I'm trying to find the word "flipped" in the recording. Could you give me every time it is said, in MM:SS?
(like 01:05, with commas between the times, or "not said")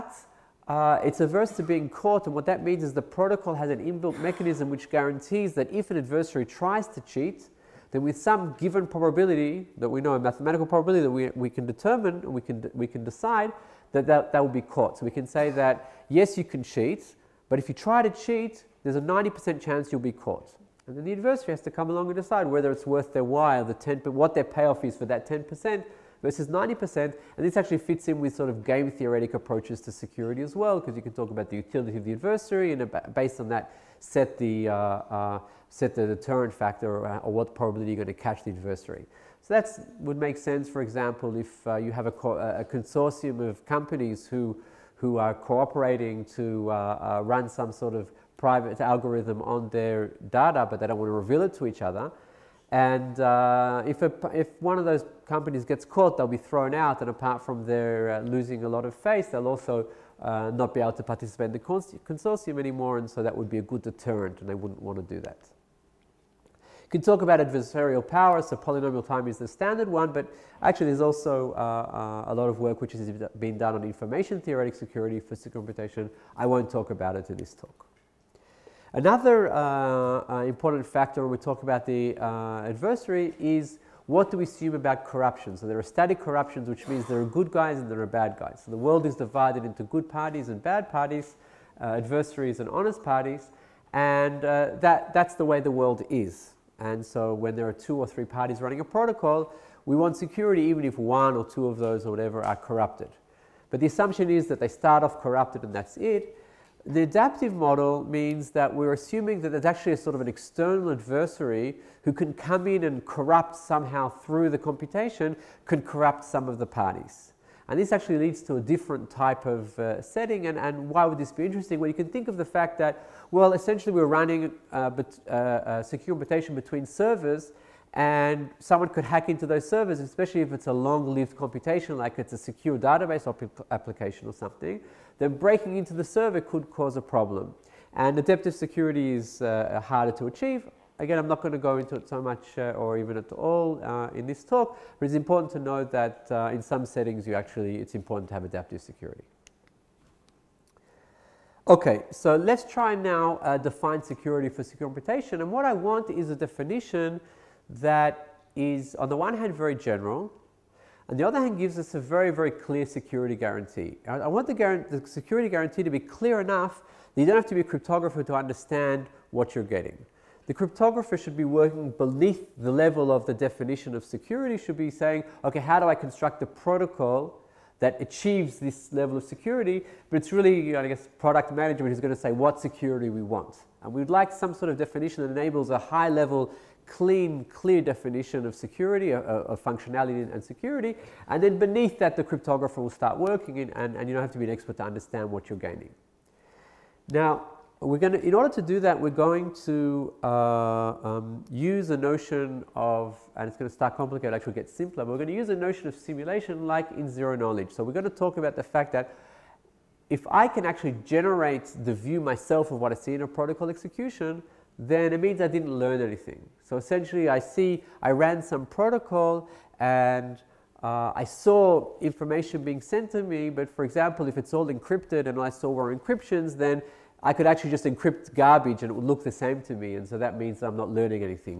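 not said.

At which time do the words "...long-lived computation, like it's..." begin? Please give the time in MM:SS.
02:10.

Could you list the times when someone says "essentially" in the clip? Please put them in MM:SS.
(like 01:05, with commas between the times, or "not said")
02:03, 03:36.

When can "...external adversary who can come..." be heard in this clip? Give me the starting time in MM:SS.
01:50.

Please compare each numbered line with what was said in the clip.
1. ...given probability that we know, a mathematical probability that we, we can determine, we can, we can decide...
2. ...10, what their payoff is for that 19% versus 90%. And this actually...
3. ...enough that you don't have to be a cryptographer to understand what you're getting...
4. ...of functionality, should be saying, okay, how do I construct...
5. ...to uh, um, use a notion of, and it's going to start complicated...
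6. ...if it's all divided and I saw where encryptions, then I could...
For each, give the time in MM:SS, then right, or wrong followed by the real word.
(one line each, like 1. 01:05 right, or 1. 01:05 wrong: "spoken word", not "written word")
1. 00:08 right
2. 00:23 wrong: "10", not "19"
3. 02:46 right
4. 02:53 wrong: "security", not "functionality"
5. 03:19 right
6. 03:44 wrong: "encrypted", not "divided".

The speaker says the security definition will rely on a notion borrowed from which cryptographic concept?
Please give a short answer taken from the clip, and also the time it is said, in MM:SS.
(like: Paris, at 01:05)
zero knowledge, at 03:27.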